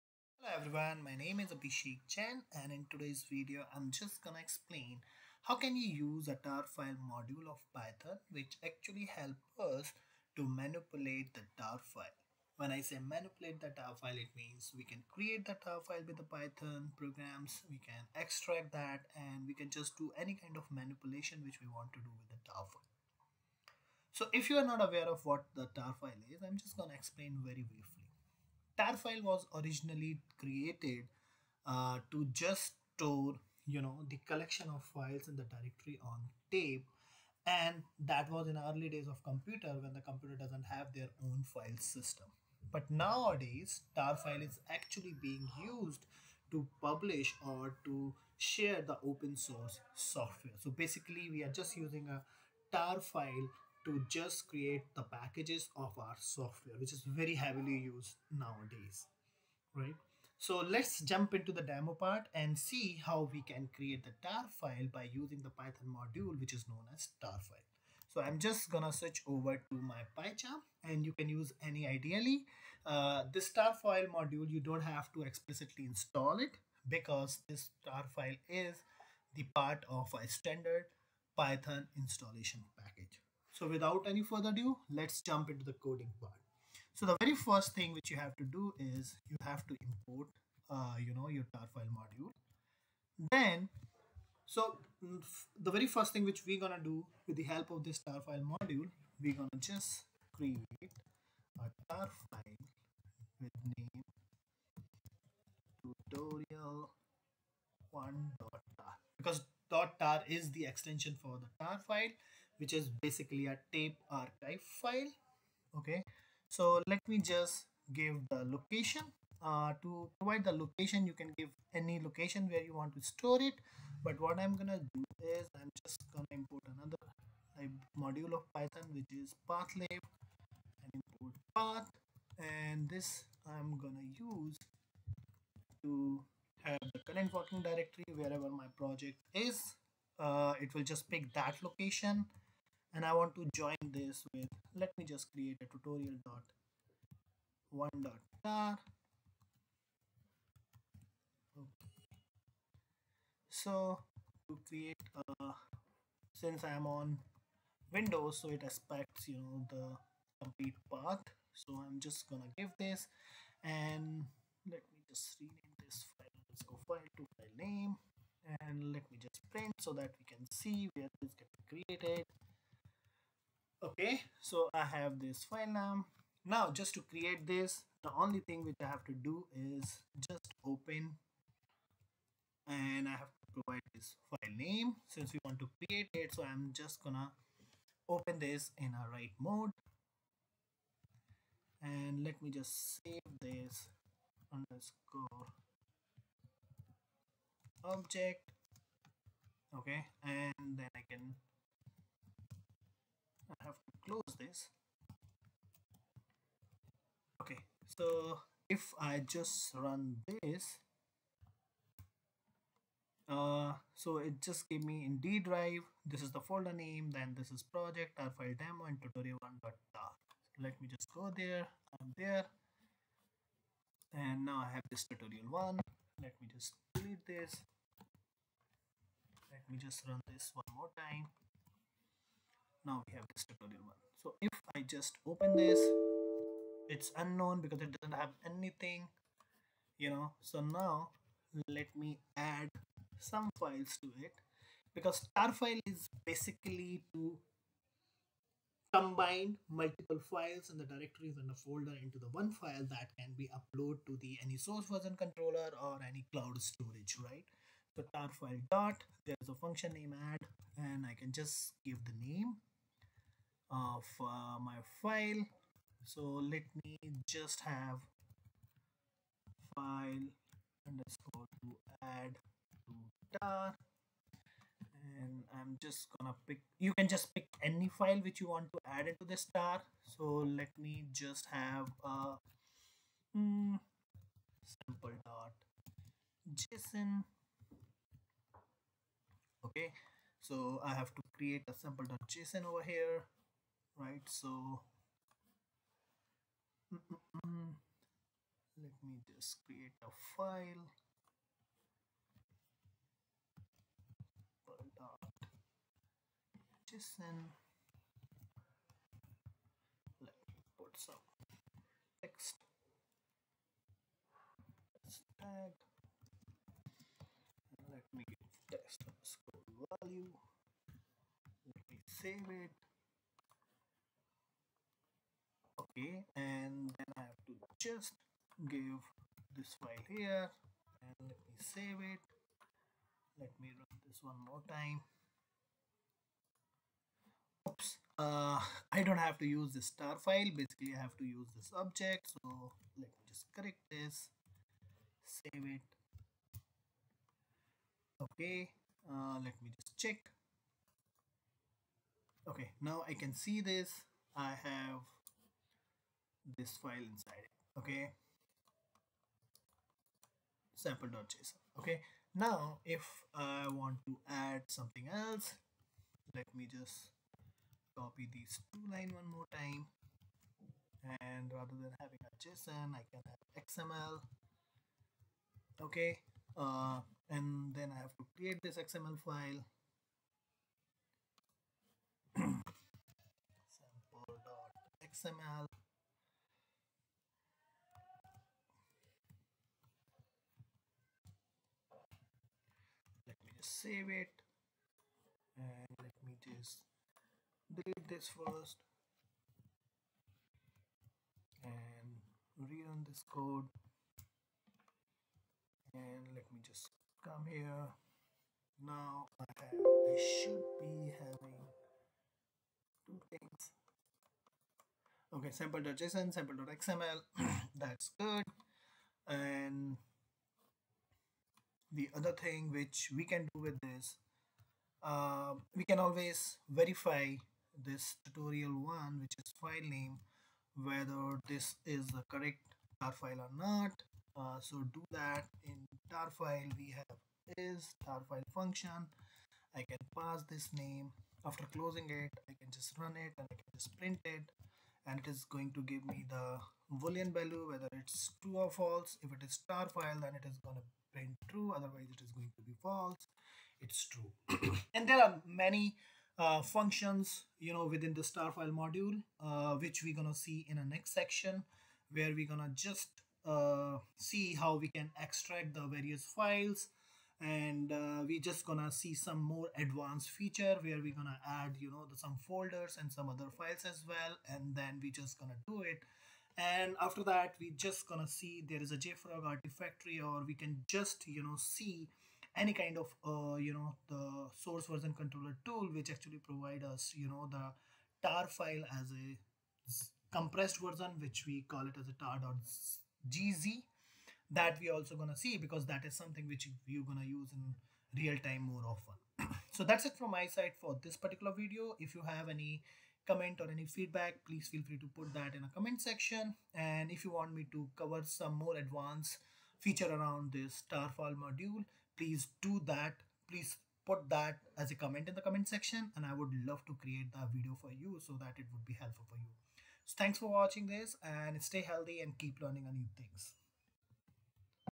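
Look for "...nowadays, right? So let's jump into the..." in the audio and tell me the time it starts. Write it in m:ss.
0:58.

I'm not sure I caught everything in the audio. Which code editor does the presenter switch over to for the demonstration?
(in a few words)
PyCharm.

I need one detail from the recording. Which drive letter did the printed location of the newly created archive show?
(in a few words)
D drive.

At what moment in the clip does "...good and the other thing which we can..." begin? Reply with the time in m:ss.
6:58.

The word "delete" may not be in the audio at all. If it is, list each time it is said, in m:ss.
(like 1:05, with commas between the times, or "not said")
3:46, 6:37.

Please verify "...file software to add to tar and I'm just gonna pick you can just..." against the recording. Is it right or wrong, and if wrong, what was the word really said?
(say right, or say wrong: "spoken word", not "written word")
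wrong: "underscore", not "software".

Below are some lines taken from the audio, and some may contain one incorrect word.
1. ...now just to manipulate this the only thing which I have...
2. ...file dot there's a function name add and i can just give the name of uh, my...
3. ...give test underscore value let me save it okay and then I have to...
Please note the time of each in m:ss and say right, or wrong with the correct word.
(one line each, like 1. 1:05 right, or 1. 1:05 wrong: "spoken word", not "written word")
1. 2:56 wrong: "create", not "manipulate"
2. 4:18 right
3. 5:18 right.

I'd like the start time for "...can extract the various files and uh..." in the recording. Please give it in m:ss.
7:44.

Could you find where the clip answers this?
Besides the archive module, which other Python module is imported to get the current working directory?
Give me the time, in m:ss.
2:09.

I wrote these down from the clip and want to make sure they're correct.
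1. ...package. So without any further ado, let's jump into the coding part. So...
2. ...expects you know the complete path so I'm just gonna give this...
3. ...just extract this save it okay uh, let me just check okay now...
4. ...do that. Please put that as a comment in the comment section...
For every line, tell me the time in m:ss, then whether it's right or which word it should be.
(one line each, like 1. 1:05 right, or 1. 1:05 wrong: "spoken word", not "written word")
1. 1:22 right
2. 2:38 right
3. 5:43 wrong: "correct", not "extract"
4. 8:32 right.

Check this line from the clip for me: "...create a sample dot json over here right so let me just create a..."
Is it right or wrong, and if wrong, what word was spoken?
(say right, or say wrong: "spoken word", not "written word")
right.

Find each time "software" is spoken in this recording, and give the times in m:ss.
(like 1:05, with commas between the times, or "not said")
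0:50, 0:56.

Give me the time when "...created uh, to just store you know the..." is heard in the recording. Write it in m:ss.
0:30.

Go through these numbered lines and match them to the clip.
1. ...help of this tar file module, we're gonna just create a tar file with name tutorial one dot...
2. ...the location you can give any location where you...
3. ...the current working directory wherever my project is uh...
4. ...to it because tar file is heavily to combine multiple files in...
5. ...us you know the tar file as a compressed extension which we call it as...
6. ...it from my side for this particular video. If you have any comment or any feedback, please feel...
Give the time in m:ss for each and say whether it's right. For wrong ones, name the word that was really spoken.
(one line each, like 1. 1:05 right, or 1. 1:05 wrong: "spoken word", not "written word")
1. 1:37 right
2. 2:00 right
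3. 2:16 right
4. 4:04 wrong: "basically", not "heavily"
5. 8:06 wrong: "version", not "extension"
6. 8:20 right.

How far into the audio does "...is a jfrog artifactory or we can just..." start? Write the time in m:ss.
7:58.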